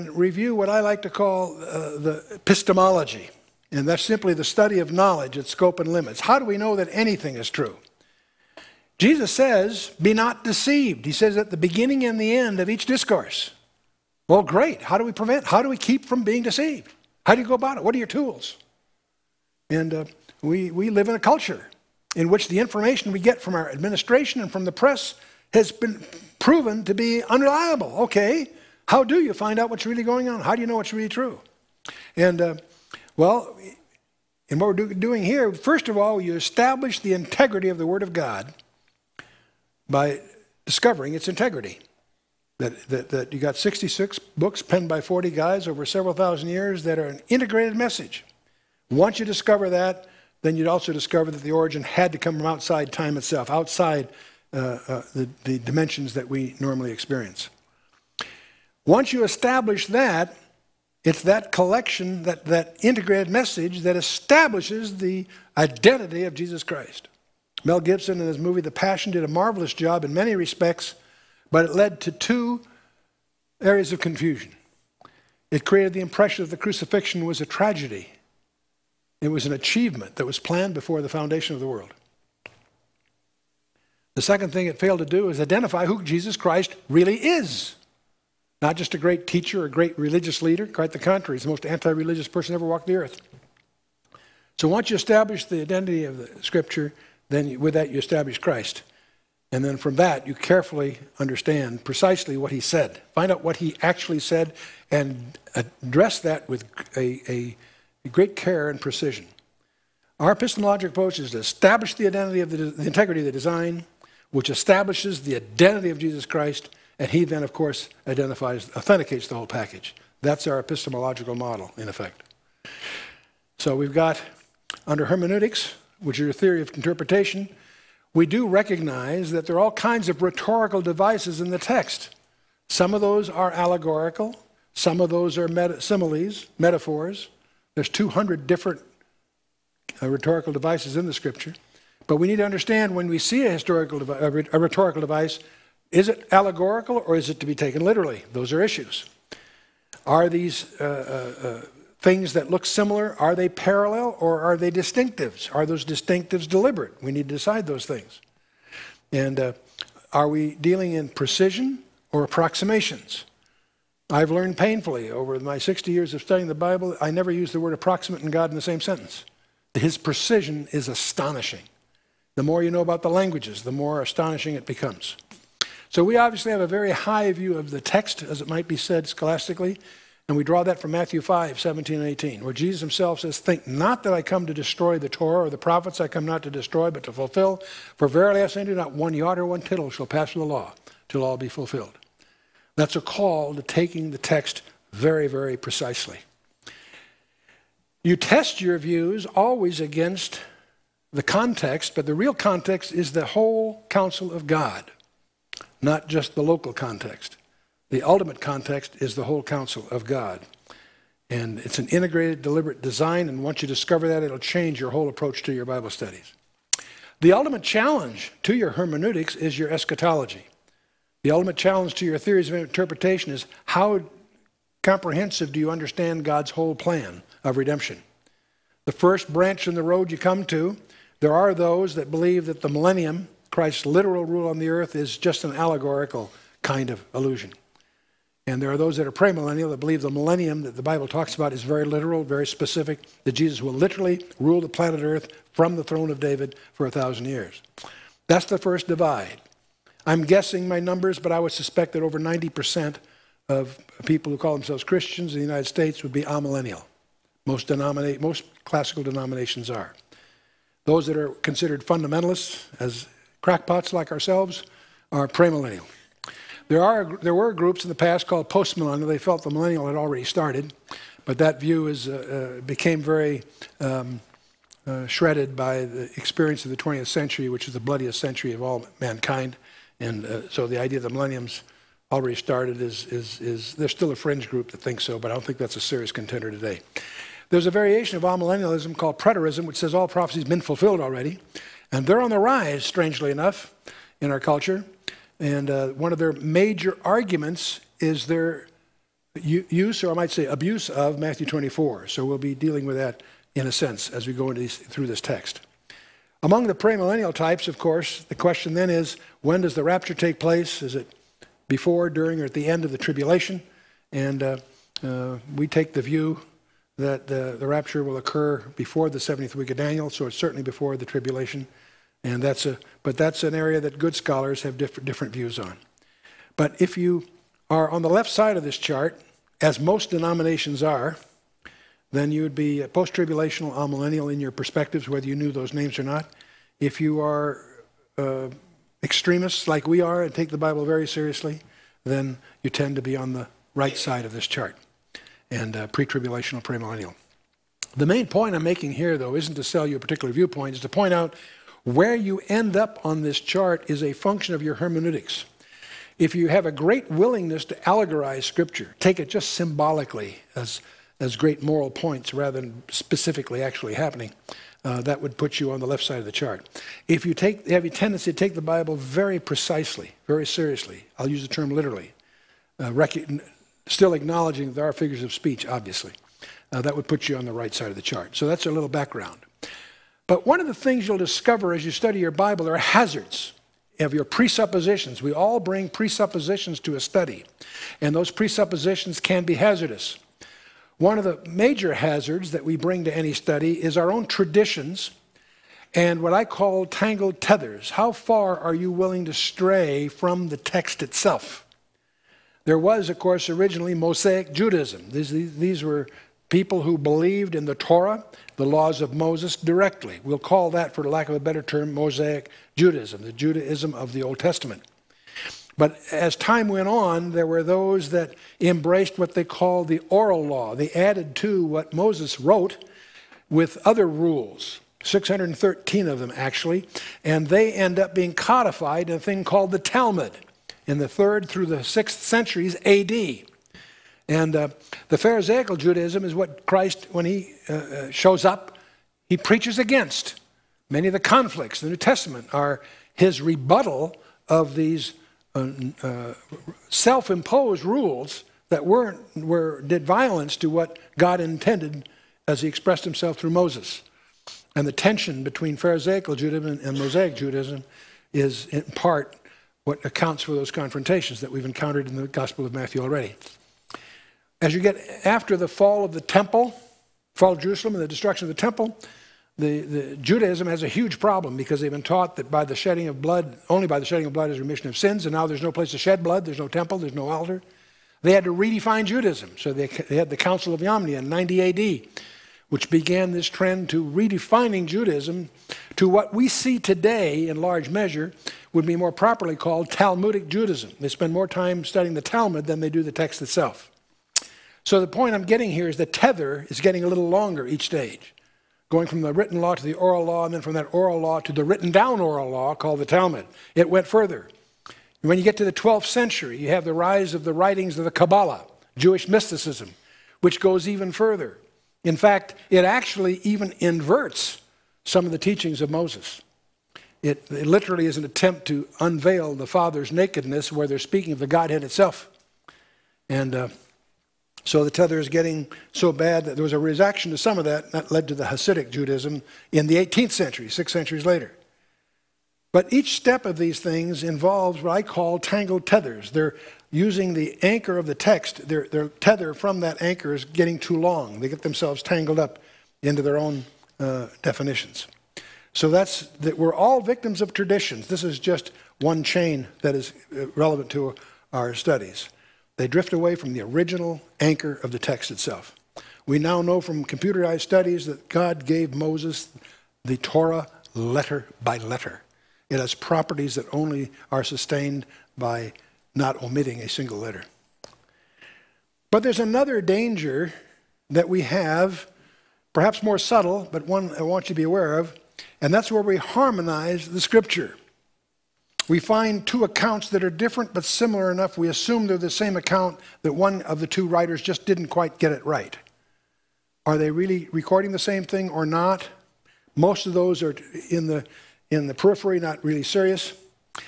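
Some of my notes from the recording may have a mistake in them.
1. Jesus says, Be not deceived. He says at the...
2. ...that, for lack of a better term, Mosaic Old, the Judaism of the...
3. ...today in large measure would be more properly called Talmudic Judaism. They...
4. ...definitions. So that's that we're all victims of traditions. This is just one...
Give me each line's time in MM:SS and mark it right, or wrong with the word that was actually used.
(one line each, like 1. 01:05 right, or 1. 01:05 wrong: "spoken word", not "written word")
1. 00:08 right
2. 06:50 wrong: "Judaism", not "Old"
3. 08:06 right
4. 09:04 right.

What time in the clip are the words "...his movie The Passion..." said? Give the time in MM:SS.
01:08.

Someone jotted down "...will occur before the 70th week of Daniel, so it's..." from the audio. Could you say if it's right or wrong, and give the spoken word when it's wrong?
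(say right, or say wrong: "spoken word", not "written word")
right.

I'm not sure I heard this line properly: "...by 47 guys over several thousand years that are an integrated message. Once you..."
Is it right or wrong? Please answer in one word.
wrong.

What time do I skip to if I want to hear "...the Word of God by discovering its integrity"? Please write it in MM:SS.
00:37.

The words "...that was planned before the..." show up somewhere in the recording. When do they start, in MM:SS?
01:20.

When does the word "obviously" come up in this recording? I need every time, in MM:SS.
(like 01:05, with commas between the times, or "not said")
02:56, 06:15.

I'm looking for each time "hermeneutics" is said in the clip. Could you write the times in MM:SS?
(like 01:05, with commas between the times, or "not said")
02:05, 03:38, 05:54.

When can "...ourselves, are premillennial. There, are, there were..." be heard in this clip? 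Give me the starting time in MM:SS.
04:24.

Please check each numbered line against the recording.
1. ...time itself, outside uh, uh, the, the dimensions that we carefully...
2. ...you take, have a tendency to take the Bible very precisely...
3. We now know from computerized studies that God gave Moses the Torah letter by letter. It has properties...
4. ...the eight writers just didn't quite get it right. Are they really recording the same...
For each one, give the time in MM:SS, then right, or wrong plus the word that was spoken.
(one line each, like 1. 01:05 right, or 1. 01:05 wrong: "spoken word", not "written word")
1. 00:52 wrong: "normally", not "carefully"
2. 06:07 right
3. 09:16 right
4. 09:43 wrong: "two", not "eight".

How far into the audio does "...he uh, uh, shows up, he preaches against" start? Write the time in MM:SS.
07:17.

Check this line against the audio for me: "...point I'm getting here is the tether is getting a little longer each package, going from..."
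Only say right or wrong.
wrong.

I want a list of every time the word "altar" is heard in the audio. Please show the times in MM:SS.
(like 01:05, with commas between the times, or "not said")
07:57.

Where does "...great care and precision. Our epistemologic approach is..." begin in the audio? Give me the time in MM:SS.
01:48.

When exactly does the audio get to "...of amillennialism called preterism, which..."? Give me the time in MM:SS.
04:48.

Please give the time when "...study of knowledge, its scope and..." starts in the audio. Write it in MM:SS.
00:04.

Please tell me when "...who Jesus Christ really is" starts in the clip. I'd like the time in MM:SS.
01:25.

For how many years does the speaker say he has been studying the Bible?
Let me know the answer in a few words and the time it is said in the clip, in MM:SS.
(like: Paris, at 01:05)
60, at 02:45.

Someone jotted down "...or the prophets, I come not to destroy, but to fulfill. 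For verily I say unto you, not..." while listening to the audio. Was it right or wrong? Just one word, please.
right.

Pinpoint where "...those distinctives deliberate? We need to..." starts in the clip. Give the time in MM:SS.
02:35.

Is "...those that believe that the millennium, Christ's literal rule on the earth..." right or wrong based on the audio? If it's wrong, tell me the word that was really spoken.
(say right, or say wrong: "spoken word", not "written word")
right.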